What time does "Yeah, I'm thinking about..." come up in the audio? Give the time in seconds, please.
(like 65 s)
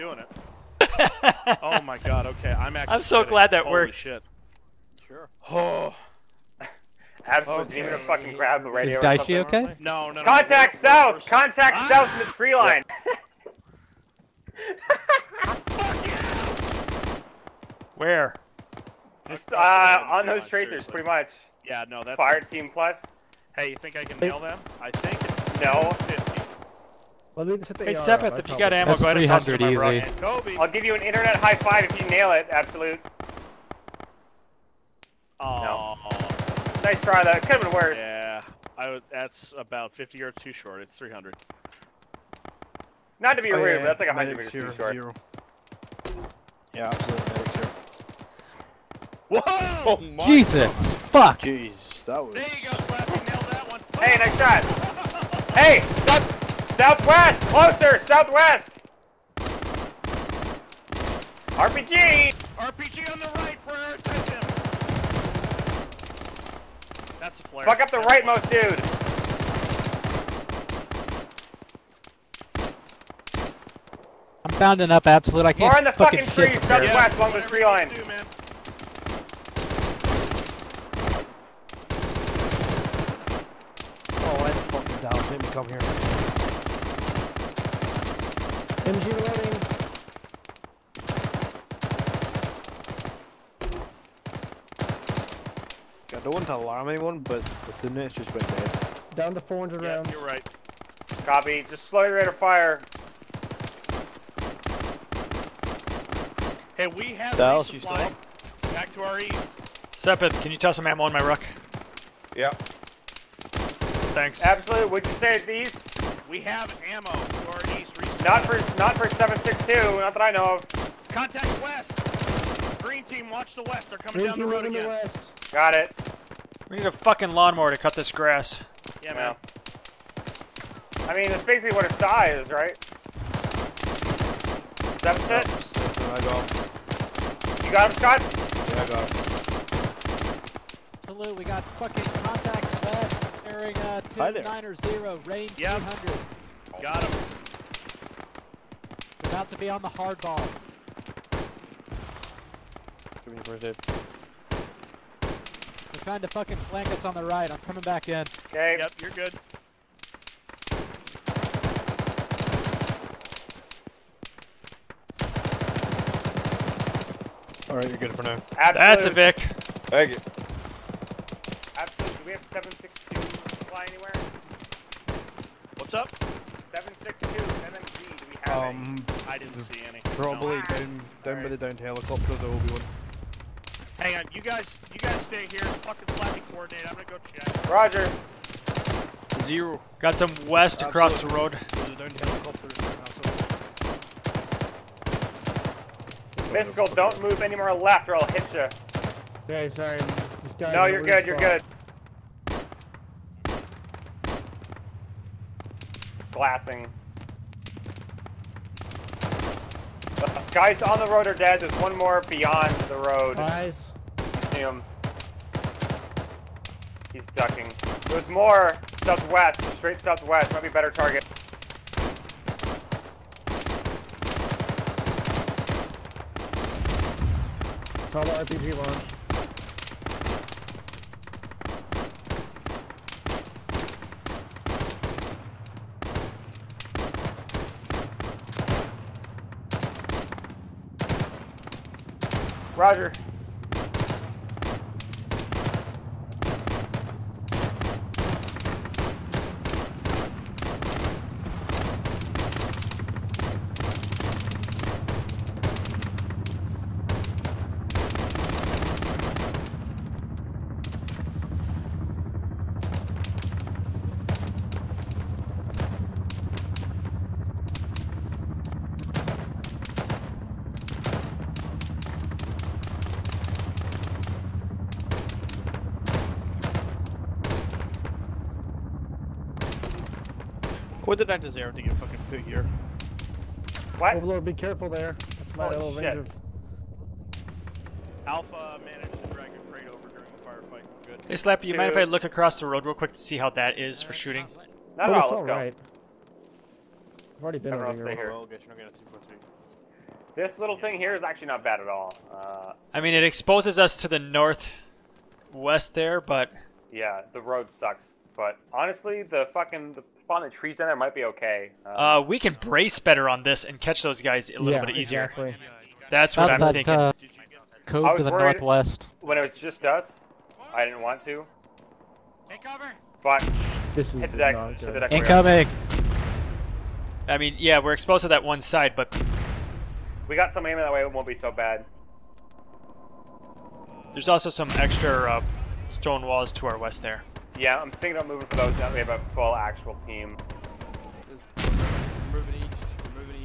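337 s.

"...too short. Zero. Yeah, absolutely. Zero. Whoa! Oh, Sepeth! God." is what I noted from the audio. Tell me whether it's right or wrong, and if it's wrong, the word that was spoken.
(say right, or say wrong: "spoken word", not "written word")
wrong: "Jesus", not "Sepeth".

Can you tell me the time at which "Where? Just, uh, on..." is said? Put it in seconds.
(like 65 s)
17 s.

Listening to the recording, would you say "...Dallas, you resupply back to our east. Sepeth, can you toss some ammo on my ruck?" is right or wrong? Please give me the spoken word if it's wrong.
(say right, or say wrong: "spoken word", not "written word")
right.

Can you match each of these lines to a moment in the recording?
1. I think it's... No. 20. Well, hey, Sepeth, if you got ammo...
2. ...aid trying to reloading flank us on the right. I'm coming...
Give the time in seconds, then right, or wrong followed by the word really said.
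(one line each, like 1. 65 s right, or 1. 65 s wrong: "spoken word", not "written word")
1. 24 s wrong: "50", not "20"
2. 153 s wrong: "fucking", not "reloading".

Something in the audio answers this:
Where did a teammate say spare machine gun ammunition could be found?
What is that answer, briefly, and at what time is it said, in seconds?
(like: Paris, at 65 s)
By the downed helicopter, at 181 s.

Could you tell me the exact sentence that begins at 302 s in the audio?
Uh, I mean, it exposes us to the northwest there, but...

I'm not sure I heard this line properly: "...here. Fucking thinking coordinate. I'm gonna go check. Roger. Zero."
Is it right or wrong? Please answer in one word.
wrong.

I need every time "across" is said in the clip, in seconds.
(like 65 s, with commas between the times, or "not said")
190 s, 292 s.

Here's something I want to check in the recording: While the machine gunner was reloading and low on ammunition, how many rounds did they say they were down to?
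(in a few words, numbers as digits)
400.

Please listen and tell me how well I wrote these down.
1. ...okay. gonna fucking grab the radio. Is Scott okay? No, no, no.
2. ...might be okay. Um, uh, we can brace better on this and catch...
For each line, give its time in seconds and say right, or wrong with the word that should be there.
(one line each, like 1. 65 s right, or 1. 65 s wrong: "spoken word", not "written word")
1. 7 s wrong: "Daishi", not "Scott"
2. 310 s right.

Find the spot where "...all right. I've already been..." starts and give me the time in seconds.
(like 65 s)
295 s.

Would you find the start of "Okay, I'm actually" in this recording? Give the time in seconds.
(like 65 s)
2 s.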